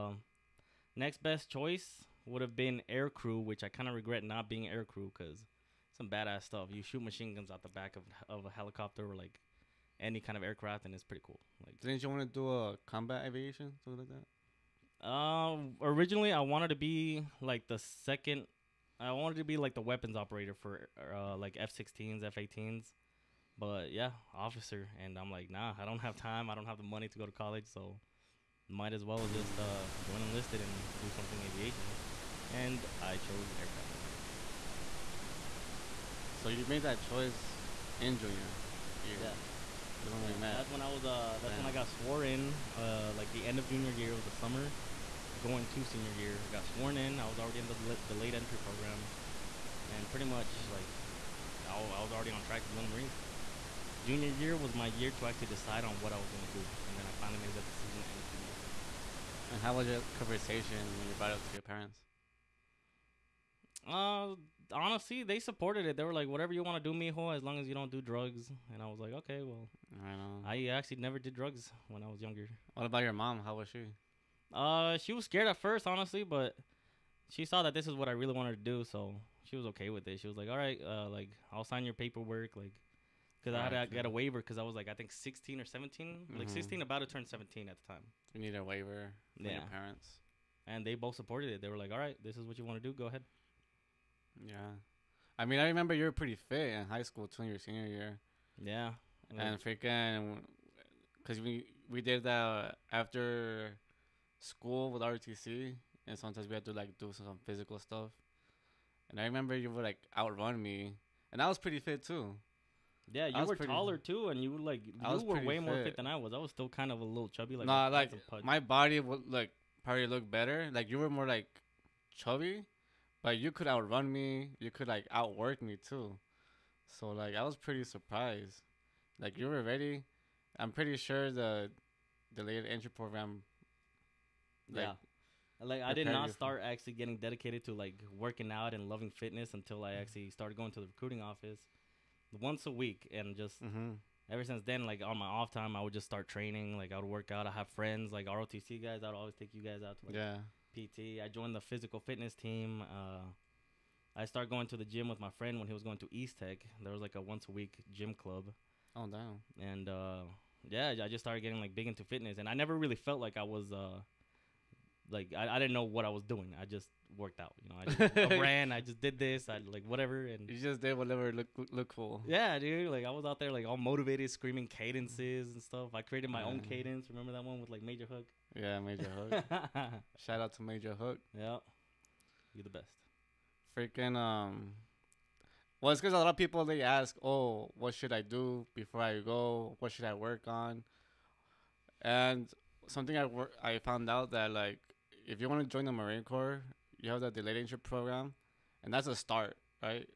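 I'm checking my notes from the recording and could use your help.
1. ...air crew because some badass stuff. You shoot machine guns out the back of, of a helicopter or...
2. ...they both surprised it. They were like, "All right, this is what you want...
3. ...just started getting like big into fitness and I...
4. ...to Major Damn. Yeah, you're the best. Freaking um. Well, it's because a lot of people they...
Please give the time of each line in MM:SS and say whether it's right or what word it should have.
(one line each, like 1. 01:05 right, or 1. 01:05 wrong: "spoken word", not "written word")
1. 00:04 right
2. 01:30 wrong: "supported", not "surprised"
3. 02:41 right
4. 03:00 wrong: "Hook", not "Damn".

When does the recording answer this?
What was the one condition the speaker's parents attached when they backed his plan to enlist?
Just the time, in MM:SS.
01:07.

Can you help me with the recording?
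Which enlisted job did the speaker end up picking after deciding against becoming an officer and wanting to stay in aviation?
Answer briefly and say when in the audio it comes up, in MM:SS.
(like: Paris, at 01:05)
Aircraft mechanic, at 00:33.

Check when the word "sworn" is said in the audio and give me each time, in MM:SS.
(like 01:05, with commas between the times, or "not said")
00:41, 00:46.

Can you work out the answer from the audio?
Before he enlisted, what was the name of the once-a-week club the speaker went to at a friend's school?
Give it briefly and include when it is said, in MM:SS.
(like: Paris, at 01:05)
Gym club, at 02:37.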